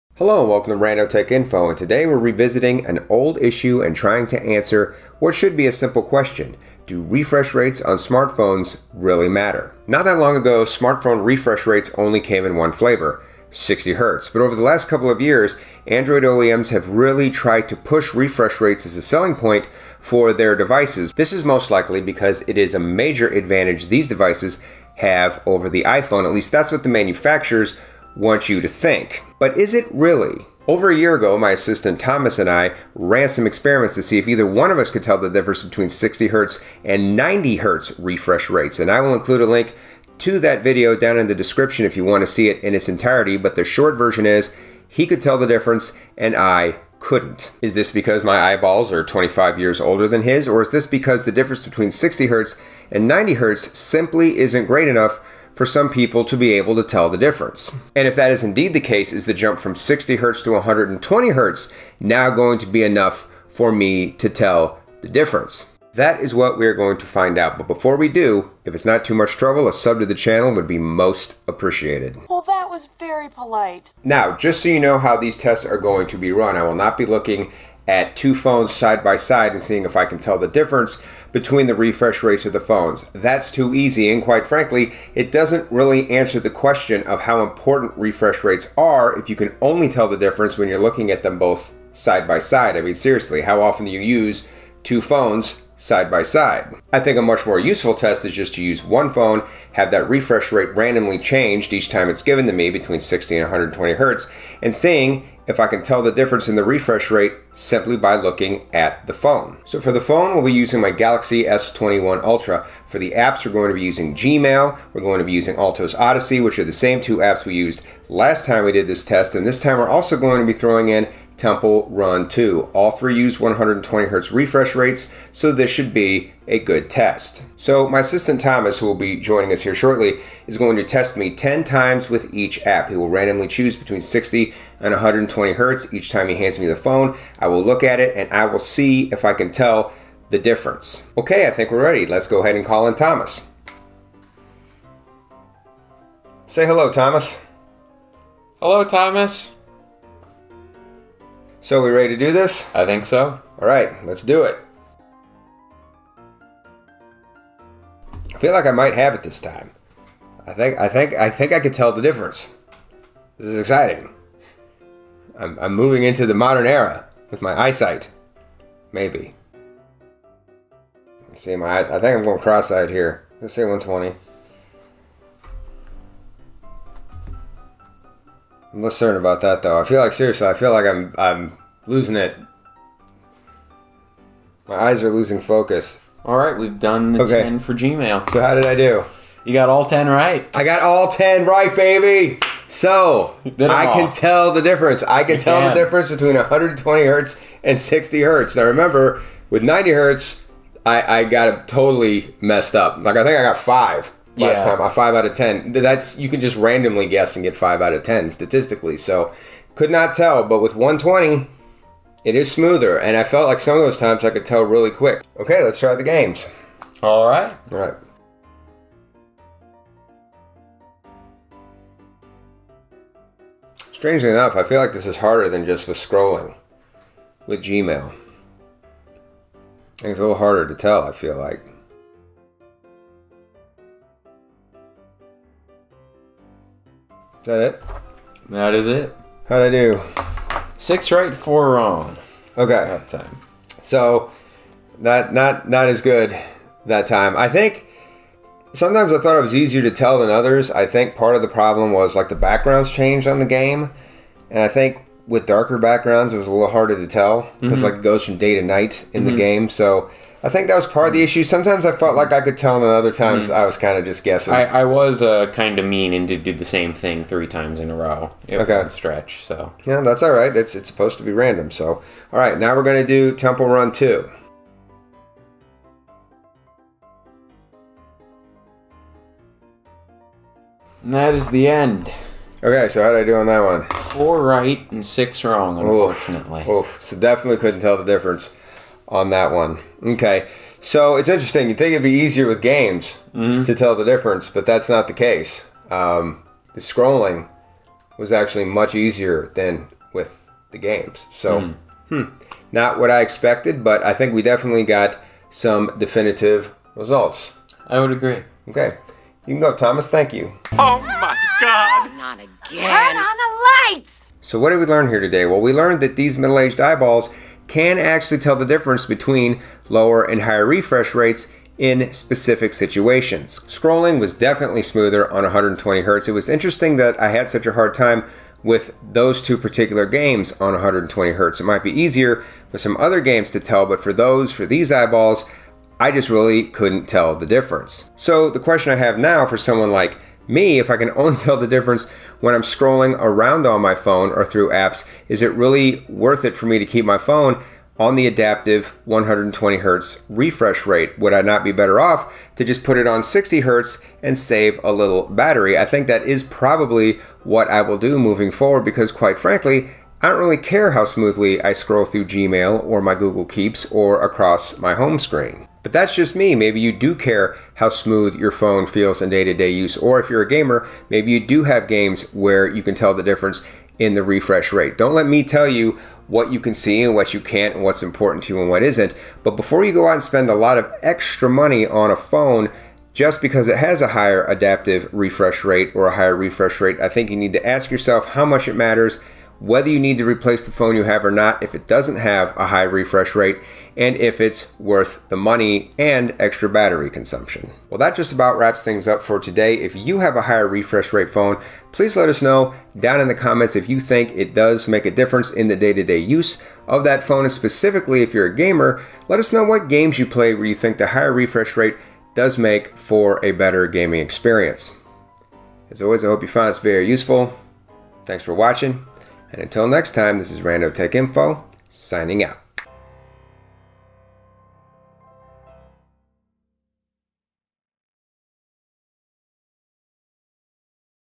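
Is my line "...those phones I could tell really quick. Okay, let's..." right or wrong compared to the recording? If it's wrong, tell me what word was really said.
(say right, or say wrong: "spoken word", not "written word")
wrong: "times", not "phones".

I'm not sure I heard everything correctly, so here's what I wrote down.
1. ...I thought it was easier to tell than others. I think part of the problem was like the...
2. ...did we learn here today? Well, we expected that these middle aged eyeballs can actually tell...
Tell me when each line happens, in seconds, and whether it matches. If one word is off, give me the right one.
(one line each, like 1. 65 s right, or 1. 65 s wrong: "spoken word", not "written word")
1. 249 s right
2. 314 s wrong: "learned", not "expected".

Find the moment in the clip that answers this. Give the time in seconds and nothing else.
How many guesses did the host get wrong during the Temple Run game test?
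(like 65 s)
285 s.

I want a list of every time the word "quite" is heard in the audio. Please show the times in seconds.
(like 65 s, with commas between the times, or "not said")
84 s, 359 s.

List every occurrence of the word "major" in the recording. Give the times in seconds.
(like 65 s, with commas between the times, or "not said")
22 s.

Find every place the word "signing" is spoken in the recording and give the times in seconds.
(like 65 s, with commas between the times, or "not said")
421 s.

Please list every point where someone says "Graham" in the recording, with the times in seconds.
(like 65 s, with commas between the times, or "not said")
not said.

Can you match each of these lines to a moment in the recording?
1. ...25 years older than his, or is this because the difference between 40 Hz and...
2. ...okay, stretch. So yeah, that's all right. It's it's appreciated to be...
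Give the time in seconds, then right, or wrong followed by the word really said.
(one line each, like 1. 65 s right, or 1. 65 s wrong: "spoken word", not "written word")
1. 49 s wrong: "60", not "40"
2. 268 s wrong: "supposed", not "appreciated".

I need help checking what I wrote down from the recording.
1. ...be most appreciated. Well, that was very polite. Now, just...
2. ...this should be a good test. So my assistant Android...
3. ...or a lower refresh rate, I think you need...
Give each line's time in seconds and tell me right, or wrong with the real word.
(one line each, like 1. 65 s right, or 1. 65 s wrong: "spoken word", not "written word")
1. 70 s right
2. 125 s wrong: "Thomas", not "Android"
3. 385 s wrong: "higher", not "lower".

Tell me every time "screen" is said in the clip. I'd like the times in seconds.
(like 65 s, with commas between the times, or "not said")
365 s.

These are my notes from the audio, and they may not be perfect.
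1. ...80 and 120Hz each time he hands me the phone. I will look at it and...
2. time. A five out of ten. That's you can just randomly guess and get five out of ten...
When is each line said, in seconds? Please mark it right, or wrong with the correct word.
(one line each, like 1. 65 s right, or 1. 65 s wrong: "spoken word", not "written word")
1. 134 s wrong: "60", not "80"
2. 204 s right.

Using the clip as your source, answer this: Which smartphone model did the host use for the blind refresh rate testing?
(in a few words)
Galaxy S21 Ultra.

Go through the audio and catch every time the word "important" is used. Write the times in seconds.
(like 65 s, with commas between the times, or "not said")
87 s, 378 s.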